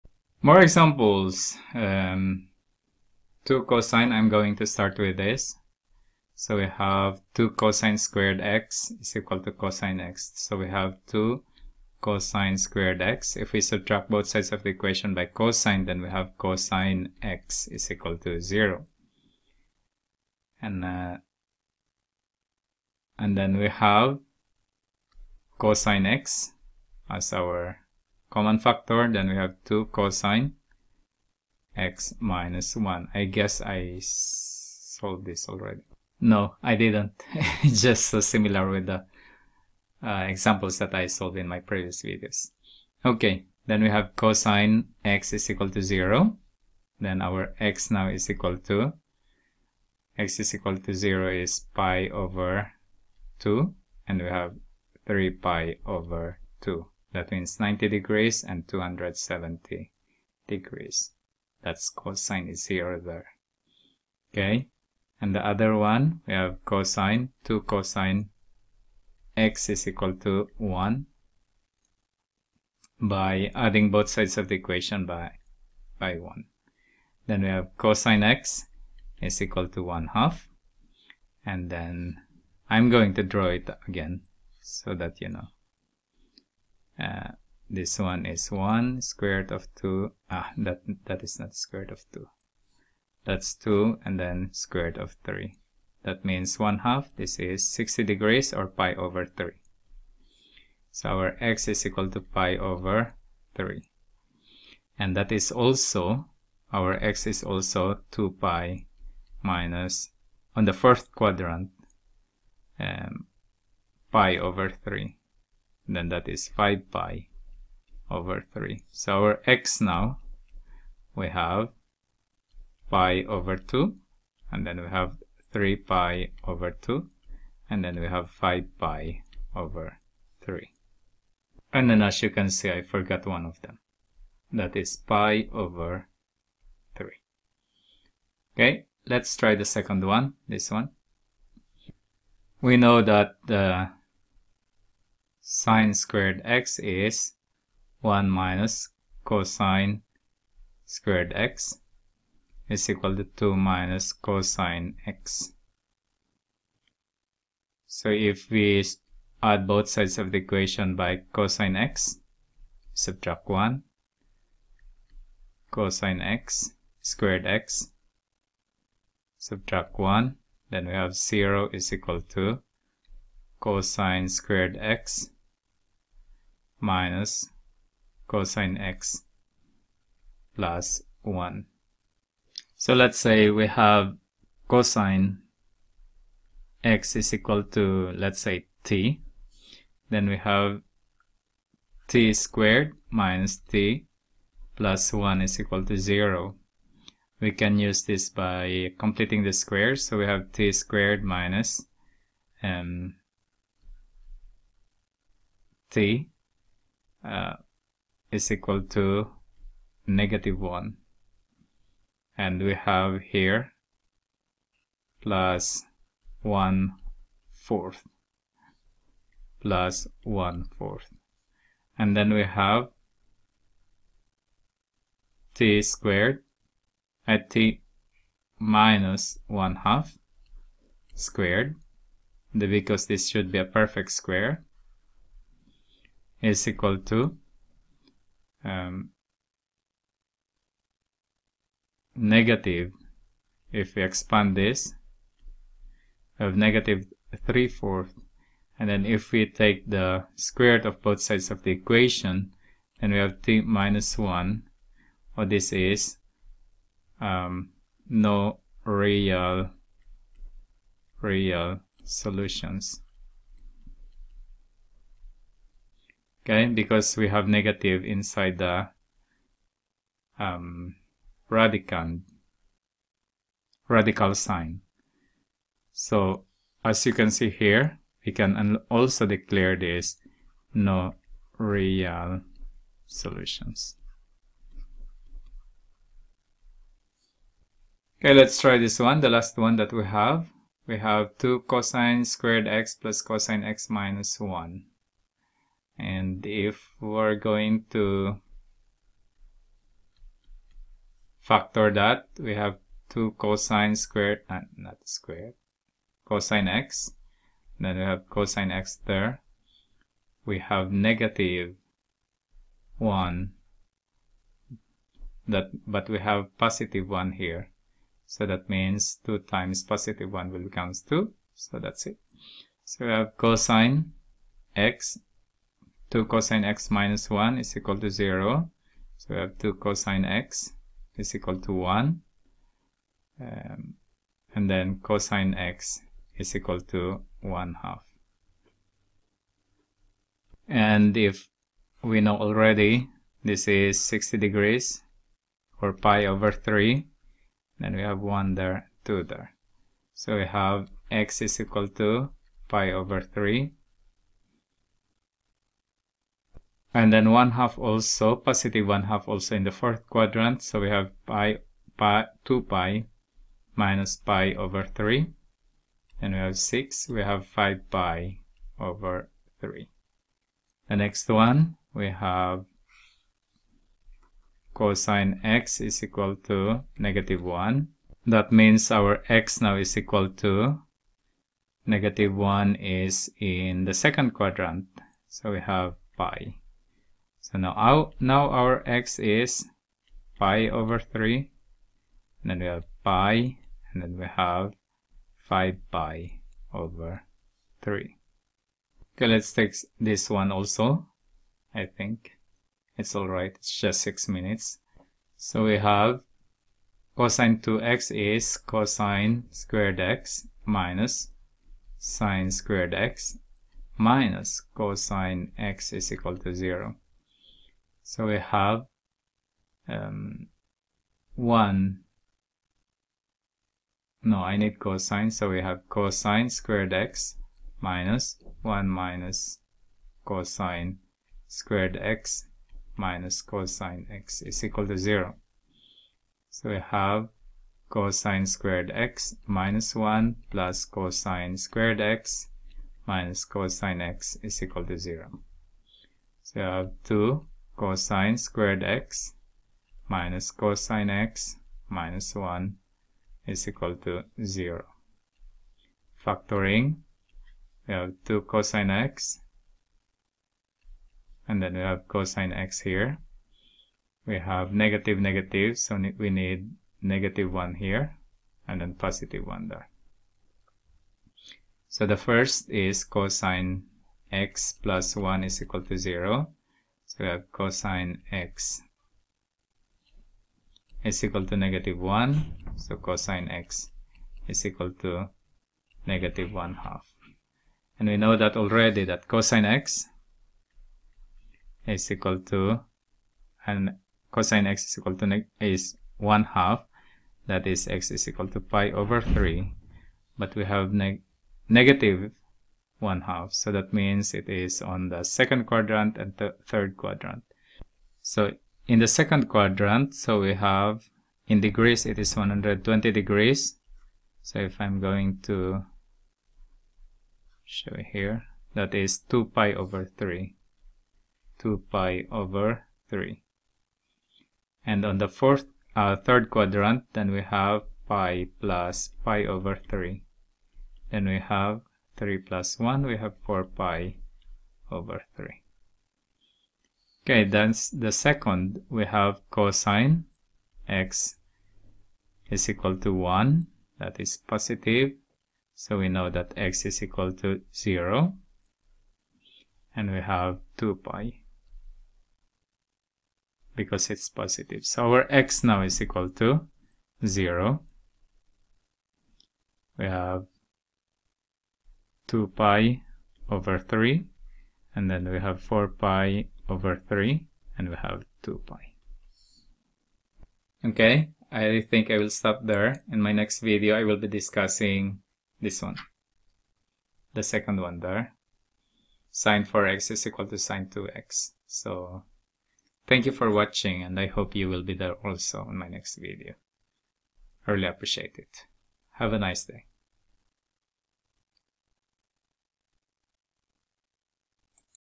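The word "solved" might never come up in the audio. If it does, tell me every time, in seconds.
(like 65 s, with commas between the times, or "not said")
34 s, 41 s.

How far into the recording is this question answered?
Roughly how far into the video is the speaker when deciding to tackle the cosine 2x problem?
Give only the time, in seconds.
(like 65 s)
404 s.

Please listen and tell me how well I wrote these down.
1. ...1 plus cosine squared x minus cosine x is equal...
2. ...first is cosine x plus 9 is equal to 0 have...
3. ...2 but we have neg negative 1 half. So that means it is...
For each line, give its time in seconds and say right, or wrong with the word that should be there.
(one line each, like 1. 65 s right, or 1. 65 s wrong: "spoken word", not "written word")
1. 439 s right
2. 472 s wrong: "1", not "9"
3. 499 s wrong: "3", not "2".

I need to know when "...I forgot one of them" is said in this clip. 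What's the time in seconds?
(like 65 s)
132 s.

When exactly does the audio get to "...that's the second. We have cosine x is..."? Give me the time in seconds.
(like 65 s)
537 s.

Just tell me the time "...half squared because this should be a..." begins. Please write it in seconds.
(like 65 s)
229 s.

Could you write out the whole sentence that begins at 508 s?
So in the second quadrant, so we have in degrees, it is 120 degrees.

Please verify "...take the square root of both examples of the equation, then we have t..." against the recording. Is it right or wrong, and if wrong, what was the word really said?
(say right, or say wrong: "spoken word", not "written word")
wrong: "sides", not "examples".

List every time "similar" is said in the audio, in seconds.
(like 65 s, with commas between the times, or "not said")
38 s.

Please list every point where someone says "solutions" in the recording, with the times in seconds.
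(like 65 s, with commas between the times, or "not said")
262 s, 283 s.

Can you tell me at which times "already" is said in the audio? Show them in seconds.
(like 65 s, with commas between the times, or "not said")
35 s, 342 s, 488 s.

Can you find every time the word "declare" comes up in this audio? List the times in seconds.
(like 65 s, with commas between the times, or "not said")
279 s.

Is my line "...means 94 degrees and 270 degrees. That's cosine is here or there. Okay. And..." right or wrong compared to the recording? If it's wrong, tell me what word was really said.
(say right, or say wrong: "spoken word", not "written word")
wrong: "90", not "94".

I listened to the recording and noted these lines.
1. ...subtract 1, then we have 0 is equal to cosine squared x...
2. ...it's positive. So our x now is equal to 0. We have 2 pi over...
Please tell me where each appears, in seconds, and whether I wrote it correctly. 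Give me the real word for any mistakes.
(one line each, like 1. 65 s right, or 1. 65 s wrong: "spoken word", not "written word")
1. 169 s right
2. 554 s right.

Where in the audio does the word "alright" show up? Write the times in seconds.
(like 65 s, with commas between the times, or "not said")
403 s.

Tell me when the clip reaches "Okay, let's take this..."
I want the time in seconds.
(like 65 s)
399 s.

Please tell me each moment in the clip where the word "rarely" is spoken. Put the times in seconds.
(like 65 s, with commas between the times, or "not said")
not said.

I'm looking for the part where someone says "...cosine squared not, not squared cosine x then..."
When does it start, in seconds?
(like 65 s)
303 s.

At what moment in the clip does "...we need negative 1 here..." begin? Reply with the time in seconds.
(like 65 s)
466 s.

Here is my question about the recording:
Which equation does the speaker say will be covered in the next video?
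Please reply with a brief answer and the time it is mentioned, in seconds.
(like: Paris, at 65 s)
sine 4x = sine 2x, at 579 s.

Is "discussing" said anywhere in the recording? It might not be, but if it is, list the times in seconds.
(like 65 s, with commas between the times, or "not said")
574 s.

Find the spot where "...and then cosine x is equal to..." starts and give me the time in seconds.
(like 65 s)
334 s.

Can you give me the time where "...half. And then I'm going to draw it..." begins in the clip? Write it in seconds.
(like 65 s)
80 s.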